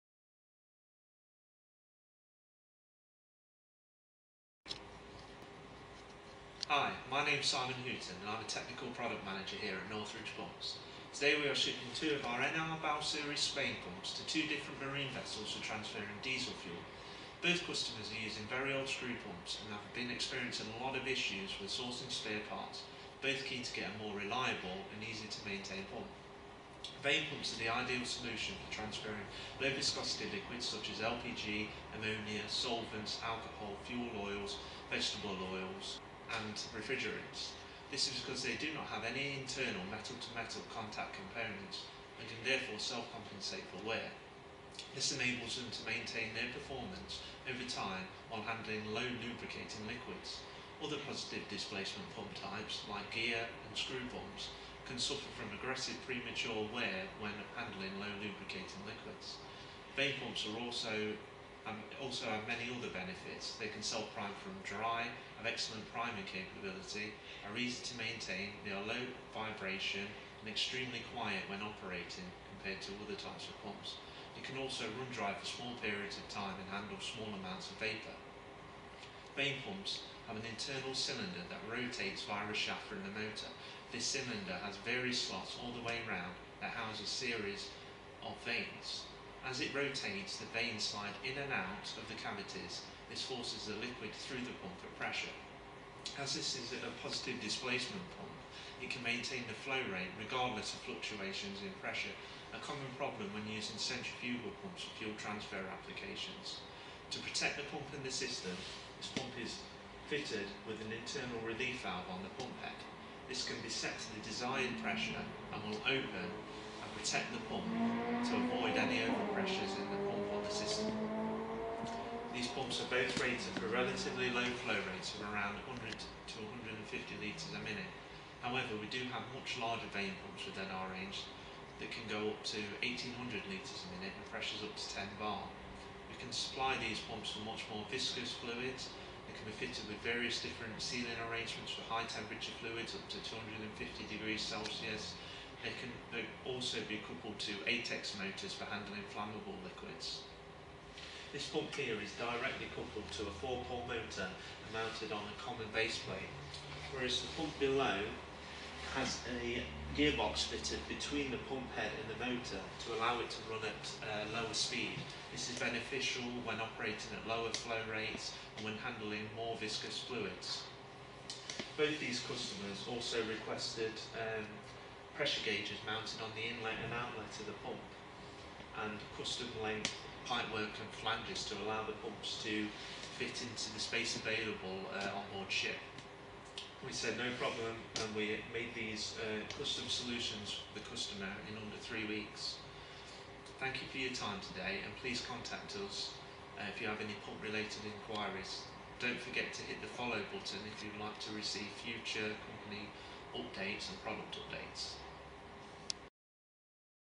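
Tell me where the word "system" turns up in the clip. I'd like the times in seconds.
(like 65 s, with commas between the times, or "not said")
108 s, 120 s.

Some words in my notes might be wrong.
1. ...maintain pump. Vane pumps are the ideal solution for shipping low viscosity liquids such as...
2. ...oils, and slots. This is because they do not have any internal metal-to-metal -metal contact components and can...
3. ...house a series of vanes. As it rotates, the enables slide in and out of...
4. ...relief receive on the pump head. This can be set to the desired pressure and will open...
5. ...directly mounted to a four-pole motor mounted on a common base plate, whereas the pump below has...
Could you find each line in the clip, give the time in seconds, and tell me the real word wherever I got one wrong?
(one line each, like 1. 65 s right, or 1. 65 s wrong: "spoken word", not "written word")
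1. 25 s wrong: "transferring", not "shipping"
2. 35 s wrong: "refrigerants", not "slots"
3. 86 s wrong: "vanes", not "enables"
4. 111 s wrong: "valve", not "receive"
5. 152 s wrong: "coupled", not "mounted".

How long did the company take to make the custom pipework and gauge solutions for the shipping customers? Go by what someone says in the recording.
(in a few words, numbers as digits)
under three weeks.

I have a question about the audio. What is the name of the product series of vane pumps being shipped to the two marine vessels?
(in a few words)
NR Bow Series.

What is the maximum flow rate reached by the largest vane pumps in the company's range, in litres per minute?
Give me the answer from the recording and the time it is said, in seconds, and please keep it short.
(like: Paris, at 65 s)
1800, at 132 s.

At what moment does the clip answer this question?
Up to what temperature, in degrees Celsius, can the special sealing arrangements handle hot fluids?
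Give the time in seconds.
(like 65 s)
143 s.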